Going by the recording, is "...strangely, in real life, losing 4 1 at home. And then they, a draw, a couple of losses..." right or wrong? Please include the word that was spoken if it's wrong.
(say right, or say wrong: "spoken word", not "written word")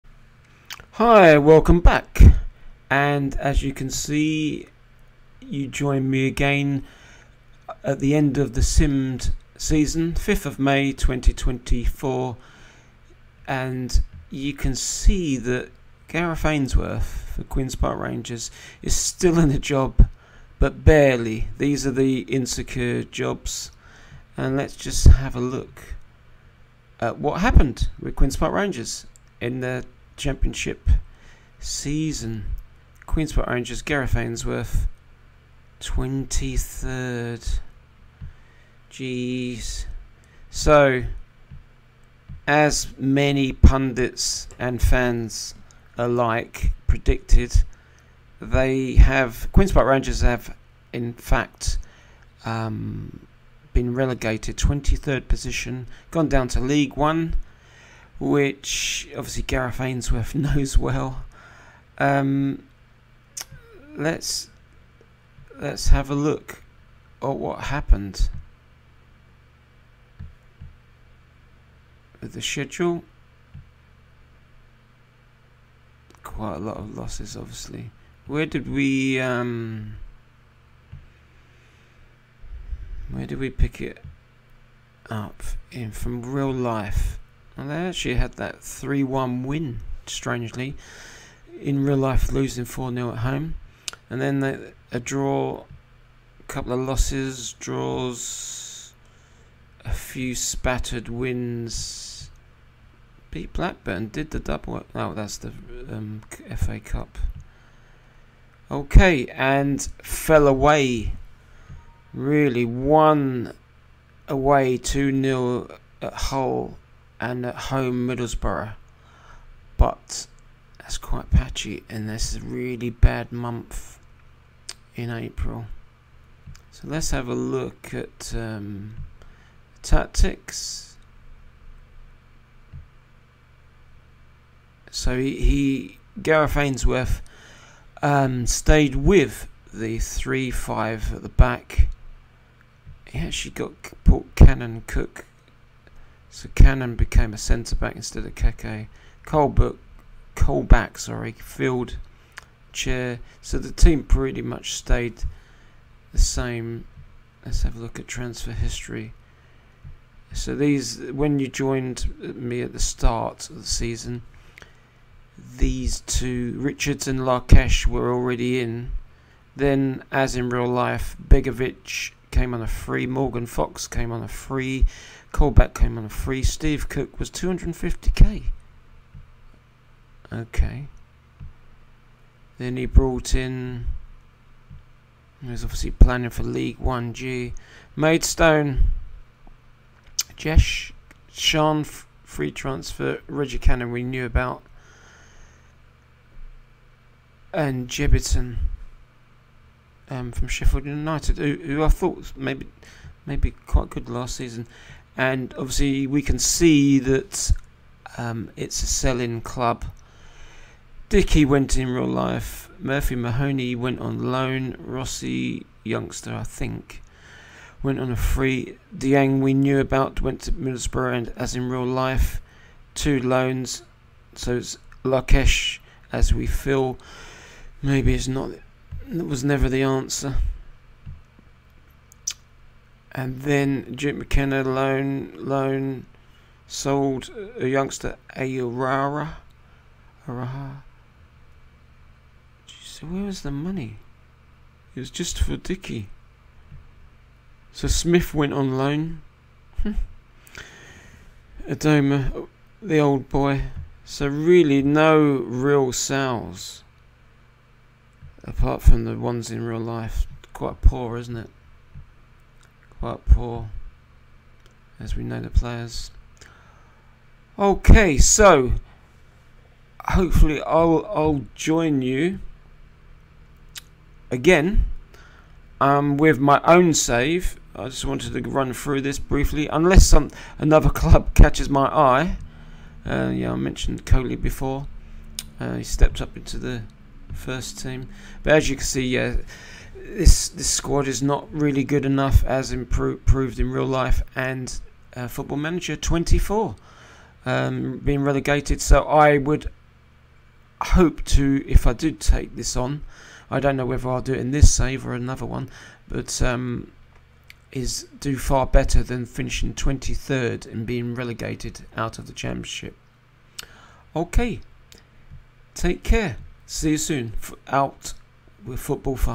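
wrong: "0", not "1".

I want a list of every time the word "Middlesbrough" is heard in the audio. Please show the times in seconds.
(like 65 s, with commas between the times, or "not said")
118 s, 220 s.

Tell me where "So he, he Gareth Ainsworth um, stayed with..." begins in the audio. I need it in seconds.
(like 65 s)
134 s.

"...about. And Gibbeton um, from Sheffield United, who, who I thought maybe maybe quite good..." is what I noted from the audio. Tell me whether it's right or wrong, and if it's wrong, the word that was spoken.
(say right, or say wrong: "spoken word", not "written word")
right.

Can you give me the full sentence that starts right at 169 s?
Then, as in real life, Begovic came on a free.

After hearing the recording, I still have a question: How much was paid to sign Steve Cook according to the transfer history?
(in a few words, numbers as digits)
250k.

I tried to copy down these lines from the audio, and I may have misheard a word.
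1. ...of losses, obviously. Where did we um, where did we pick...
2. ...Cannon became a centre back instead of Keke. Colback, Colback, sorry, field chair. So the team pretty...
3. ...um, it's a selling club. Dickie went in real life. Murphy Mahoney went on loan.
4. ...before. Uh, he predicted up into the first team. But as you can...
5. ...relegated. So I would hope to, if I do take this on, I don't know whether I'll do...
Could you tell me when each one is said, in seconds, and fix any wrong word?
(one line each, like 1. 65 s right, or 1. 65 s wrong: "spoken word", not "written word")
1. 76 s right
2. 146 s right
3. 208 s right
4. 284 s wrong: "stepped", not "predicted"
5. 298 s right.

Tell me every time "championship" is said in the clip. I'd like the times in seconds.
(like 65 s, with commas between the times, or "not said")
30 s, 312 s.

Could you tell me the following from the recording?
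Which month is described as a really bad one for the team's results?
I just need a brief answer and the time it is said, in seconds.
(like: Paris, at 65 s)
April, at 125 s.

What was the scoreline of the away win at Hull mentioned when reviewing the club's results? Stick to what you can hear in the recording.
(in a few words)
2 0.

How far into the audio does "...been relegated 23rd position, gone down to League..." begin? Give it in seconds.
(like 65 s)
53 s.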